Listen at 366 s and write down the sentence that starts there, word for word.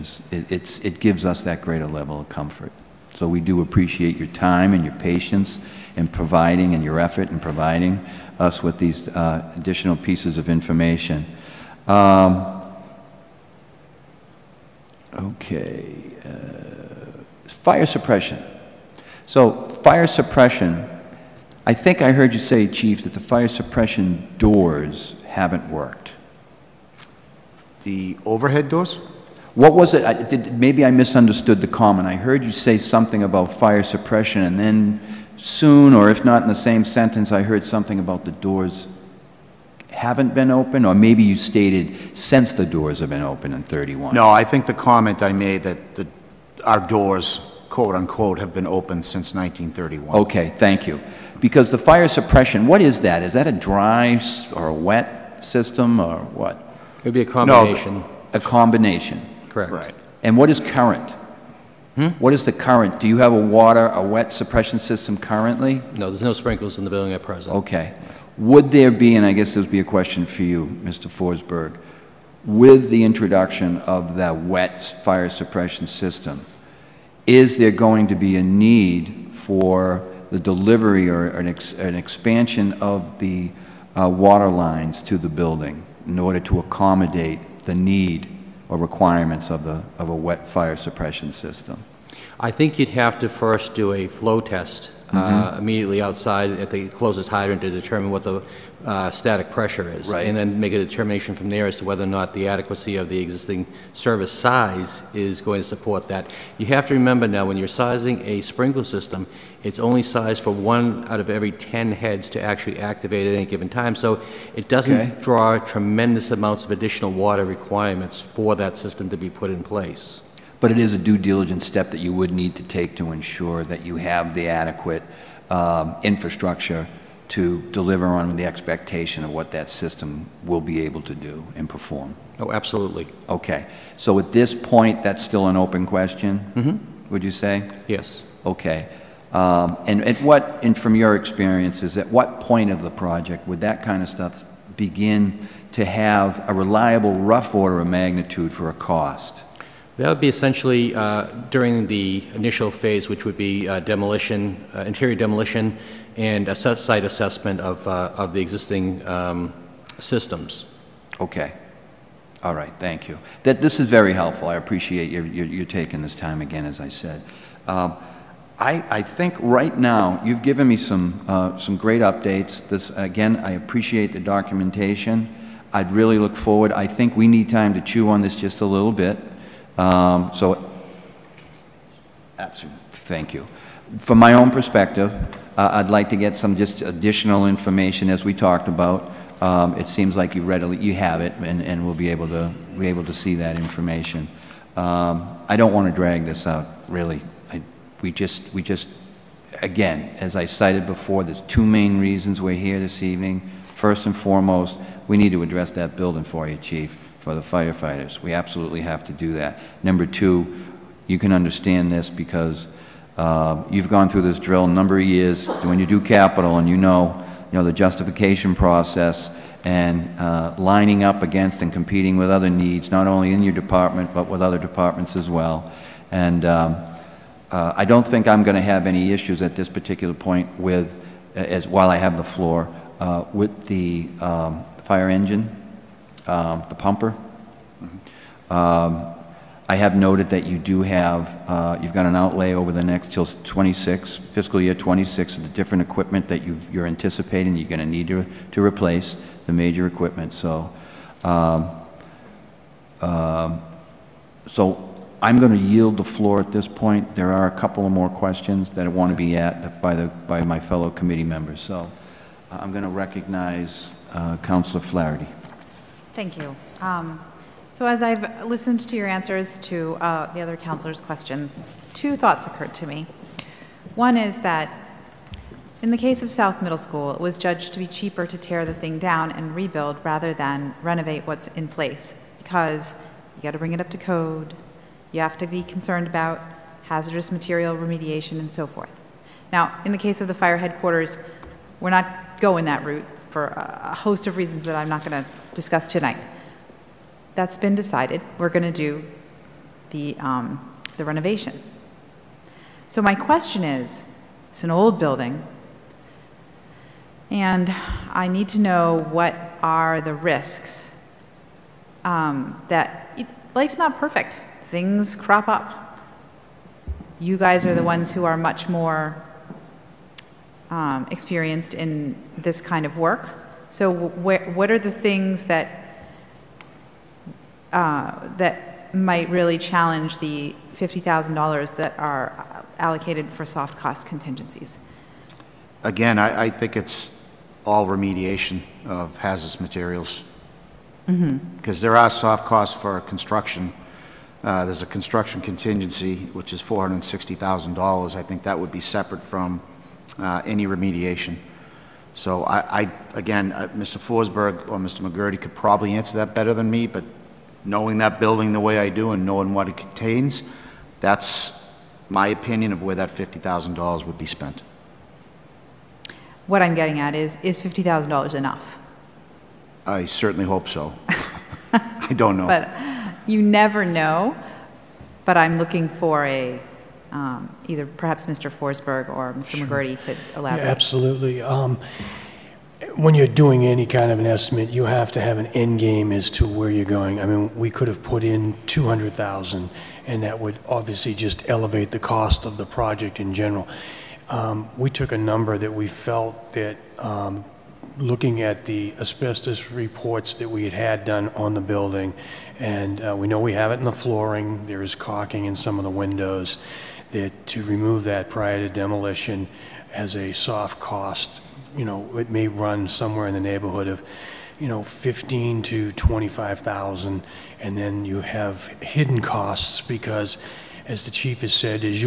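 What I'm getting at is, is $50,000 enough?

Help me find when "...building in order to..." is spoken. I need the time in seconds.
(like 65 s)
85 s.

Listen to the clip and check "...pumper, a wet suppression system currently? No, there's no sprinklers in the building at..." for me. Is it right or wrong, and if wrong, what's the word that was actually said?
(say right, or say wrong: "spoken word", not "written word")
wrong: "water", not "pumper".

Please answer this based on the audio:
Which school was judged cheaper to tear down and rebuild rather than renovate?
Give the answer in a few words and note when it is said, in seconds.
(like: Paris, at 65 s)
South Middle School, at 276 s.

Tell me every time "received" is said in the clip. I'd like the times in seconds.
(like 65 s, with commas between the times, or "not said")
not said.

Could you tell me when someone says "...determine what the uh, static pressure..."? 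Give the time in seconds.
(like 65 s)
97 s.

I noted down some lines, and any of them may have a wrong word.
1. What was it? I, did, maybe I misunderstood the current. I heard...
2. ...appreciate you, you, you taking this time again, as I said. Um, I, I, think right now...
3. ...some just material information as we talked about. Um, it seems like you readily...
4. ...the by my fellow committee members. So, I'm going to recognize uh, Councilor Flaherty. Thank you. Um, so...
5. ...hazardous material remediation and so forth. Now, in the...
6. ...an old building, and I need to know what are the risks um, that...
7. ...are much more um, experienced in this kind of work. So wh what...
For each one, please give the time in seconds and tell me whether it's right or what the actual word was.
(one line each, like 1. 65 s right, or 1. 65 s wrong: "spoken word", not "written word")
1. 29 s wrong: "comment", not "current"
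2. 164 s right
3. 186 s wrong: "additional", not "material"
4. 259 s right
5. 286 s right
6. 304 s right
7. 318 s right.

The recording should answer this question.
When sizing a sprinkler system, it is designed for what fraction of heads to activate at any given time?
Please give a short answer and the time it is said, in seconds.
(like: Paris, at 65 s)
1 out of every 10, at 110 s.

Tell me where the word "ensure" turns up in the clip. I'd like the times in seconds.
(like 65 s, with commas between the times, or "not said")
123 s.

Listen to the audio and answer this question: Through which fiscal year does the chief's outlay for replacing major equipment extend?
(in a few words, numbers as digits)
fiscal year 26.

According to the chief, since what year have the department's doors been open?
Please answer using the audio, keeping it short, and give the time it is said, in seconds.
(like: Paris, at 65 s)
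1931, at 49 s.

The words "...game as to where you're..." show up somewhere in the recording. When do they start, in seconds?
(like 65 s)
385 s.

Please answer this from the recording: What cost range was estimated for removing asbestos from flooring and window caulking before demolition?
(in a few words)
15 to 25,000.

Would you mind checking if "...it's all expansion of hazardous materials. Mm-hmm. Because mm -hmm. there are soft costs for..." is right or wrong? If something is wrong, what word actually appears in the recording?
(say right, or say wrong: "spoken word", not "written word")
wrong: "remediation", not "expansion".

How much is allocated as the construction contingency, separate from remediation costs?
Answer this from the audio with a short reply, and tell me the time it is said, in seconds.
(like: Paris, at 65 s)
$460,000, at 346 s.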